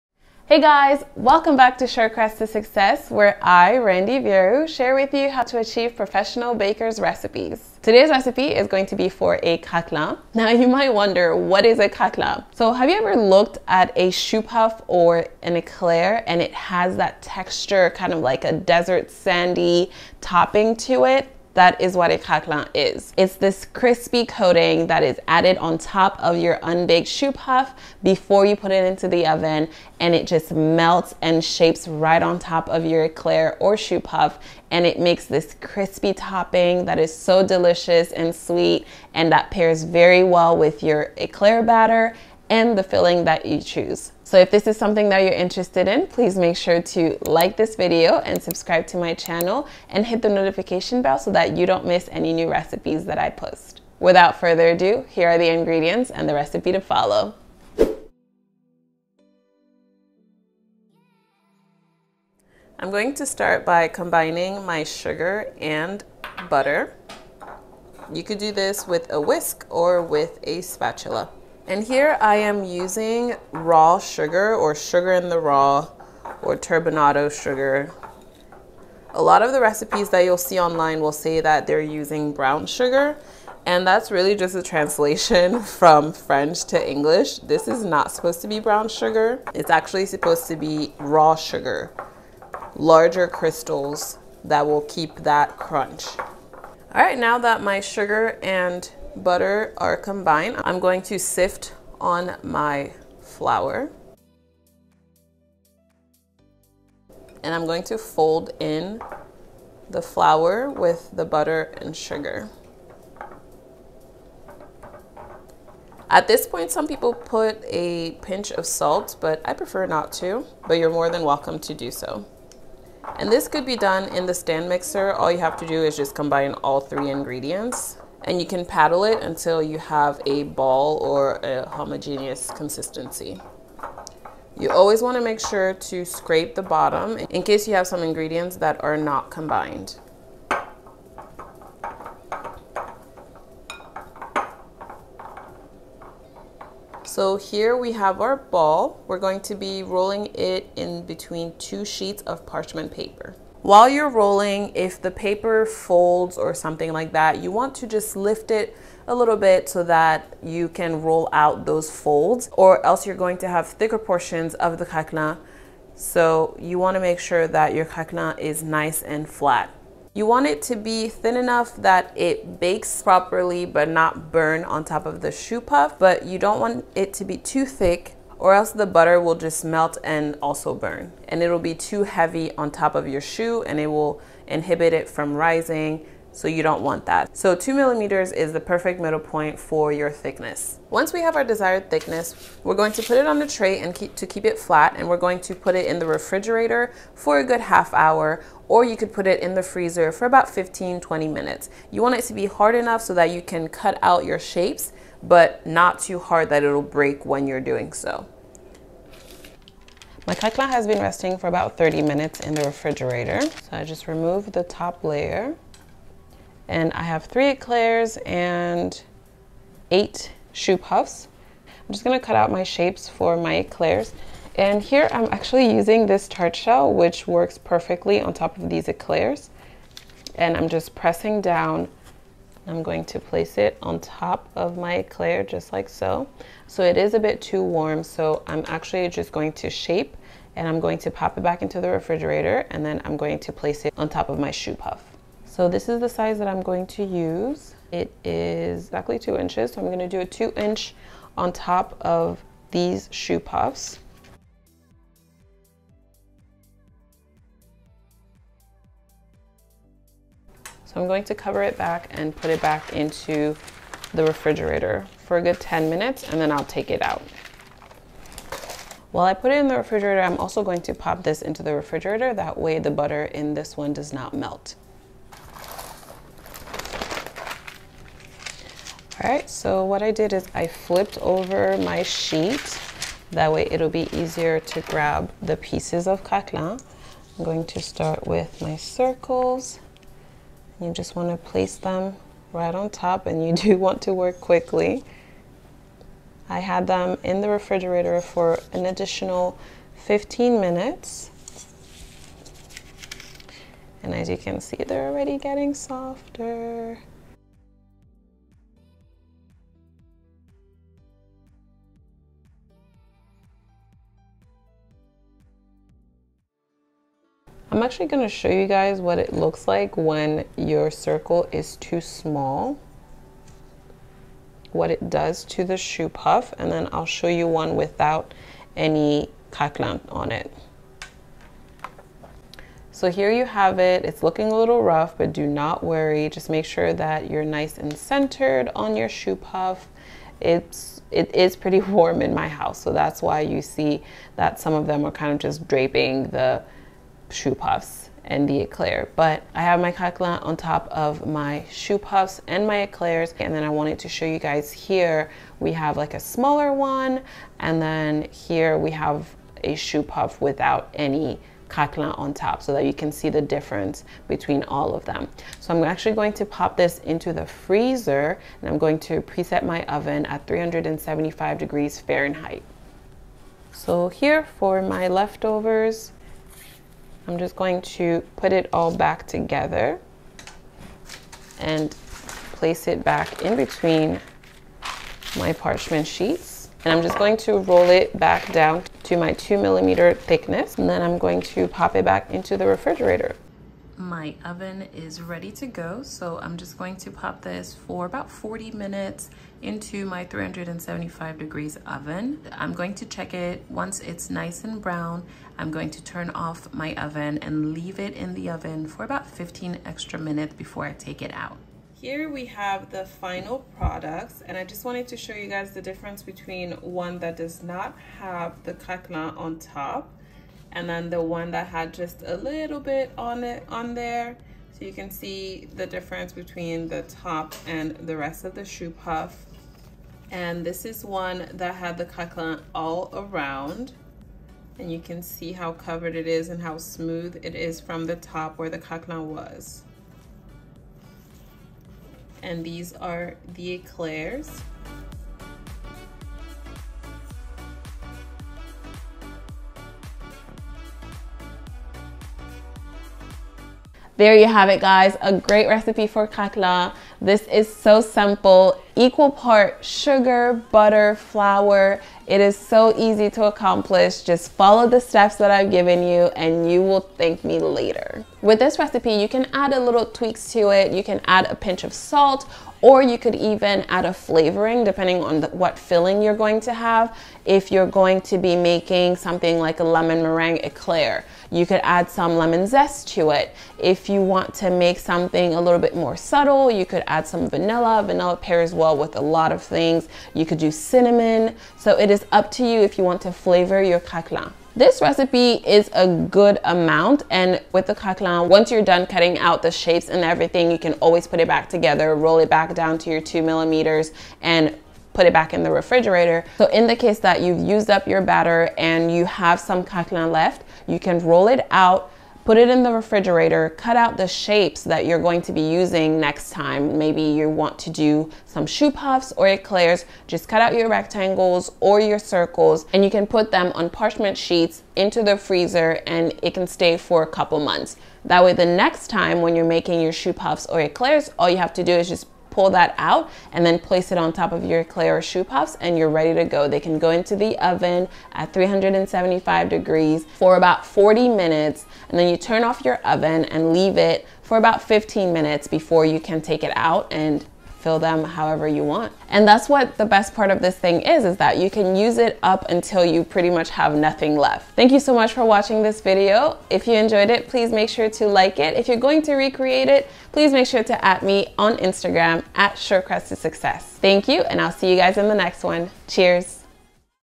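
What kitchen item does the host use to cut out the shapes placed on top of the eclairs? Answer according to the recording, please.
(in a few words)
tart shell.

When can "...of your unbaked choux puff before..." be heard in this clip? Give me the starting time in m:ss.
0:26.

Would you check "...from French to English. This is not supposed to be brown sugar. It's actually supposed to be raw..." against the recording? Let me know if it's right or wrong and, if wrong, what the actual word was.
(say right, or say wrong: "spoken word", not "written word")
right.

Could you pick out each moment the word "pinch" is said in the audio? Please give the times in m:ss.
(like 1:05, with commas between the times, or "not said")
1:58, 7:51.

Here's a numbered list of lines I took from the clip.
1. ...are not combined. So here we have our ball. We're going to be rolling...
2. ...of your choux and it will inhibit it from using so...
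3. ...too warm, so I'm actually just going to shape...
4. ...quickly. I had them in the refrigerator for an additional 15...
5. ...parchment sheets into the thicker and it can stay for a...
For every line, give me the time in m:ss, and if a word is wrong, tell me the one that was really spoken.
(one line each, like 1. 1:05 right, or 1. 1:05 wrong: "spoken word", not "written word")
1. 2:18 right
2. 3:02 wrong: "rising", not "using"
3. 3:57 right
4. 4:54 right
5. 8:43 wrong: "freezer", not "thicker".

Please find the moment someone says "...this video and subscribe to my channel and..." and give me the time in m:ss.
0:47.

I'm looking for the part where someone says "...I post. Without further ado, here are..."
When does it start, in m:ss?
0:53.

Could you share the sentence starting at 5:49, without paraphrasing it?
But I have my craquelin on top of my choux puffs and my eclairs.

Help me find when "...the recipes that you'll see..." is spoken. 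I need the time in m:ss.
1:19.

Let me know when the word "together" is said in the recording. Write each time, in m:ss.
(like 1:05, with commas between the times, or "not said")
6:19, 8:21.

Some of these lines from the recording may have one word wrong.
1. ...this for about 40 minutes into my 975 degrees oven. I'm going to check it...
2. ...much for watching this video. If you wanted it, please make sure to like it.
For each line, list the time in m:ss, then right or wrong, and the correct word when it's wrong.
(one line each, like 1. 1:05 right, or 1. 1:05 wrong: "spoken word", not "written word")
1. 6:37 wrong: "375", not "975"
2. 9:15 wrong: "enjoyed", not "wanted".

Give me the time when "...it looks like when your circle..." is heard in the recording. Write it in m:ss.
5:19.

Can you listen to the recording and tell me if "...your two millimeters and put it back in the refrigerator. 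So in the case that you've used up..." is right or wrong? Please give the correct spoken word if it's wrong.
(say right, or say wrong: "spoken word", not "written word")
right.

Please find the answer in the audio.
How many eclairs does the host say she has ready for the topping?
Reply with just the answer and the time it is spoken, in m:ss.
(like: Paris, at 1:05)
3, at 3:37.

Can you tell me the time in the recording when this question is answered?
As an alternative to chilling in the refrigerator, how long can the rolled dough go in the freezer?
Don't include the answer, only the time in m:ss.
3:20.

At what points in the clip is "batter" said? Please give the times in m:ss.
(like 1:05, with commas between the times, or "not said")
0:41, 8:28.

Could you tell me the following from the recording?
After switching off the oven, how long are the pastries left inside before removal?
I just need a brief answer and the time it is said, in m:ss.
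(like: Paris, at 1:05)
15 minutes, at 6:49.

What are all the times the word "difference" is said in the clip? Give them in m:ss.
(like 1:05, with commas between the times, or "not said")
6:03, 6:55, 7:05.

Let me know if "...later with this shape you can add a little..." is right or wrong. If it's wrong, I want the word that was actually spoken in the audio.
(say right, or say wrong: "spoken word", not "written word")
wrong: "recipe", not "shape".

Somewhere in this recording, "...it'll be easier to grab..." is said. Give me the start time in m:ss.
4:43.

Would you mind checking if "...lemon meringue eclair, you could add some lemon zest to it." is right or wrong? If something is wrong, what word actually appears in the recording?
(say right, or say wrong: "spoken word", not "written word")
right.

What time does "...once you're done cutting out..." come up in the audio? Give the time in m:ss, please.
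8:18.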